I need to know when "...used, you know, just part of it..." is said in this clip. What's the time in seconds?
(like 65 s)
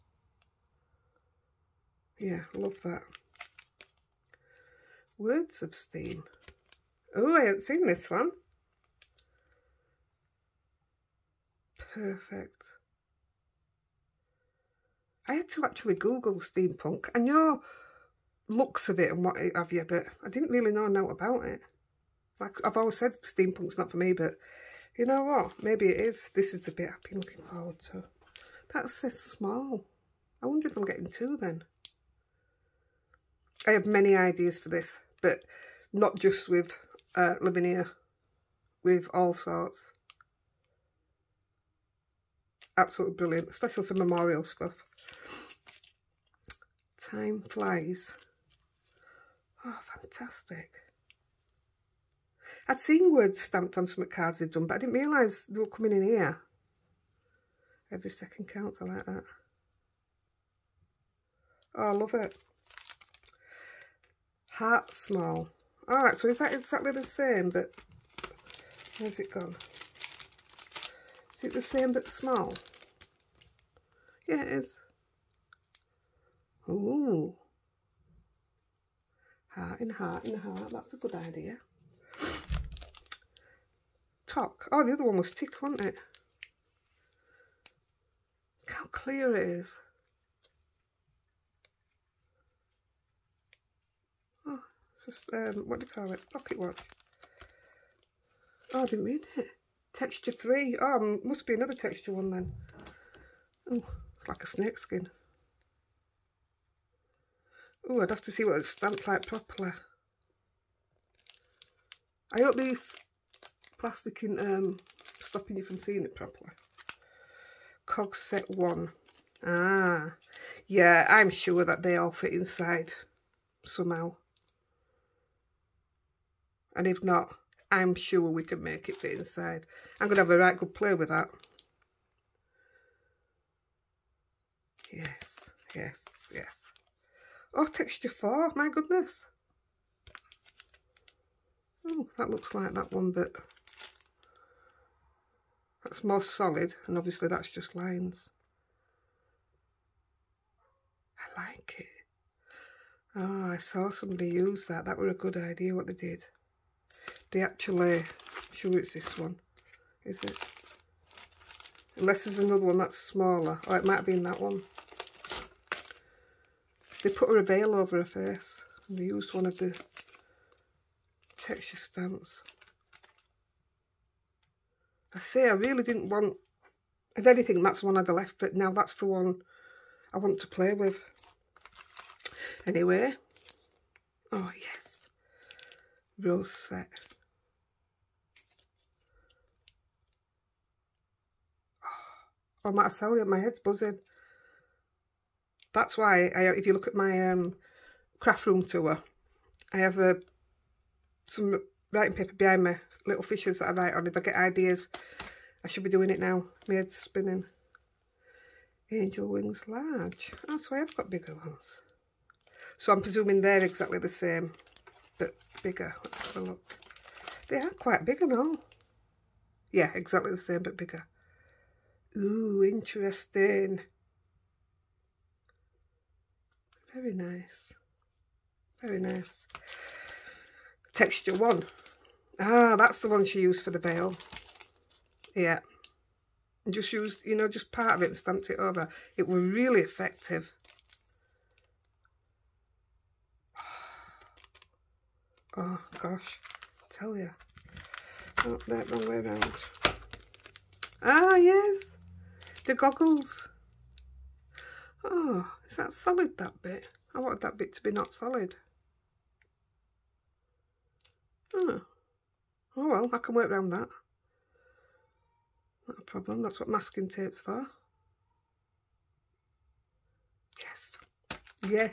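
236 s.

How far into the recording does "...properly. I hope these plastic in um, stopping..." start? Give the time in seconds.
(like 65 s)
109 s.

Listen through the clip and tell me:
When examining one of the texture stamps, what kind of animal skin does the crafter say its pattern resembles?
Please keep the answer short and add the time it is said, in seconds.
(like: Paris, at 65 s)
Snake skin, at 104 s.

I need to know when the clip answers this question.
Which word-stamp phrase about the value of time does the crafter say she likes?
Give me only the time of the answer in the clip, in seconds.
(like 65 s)
57 s.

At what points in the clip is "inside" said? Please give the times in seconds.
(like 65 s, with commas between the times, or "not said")
122 s, 129 s.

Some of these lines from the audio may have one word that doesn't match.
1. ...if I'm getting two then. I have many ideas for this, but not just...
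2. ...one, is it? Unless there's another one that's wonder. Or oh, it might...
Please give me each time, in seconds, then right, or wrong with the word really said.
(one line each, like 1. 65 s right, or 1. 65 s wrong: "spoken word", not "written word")
1. 30 s right
2. 159 s wrong: "smaller", not "wonder".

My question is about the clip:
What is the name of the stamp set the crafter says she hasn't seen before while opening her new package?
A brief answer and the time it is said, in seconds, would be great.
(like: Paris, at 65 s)
Words of Steam, at 5 s.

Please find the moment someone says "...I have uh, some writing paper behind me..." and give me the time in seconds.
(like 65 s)
199 s.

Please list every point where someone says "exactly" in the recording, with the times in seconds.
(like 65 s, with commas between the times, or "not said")
66 s, 213 s, 219 s.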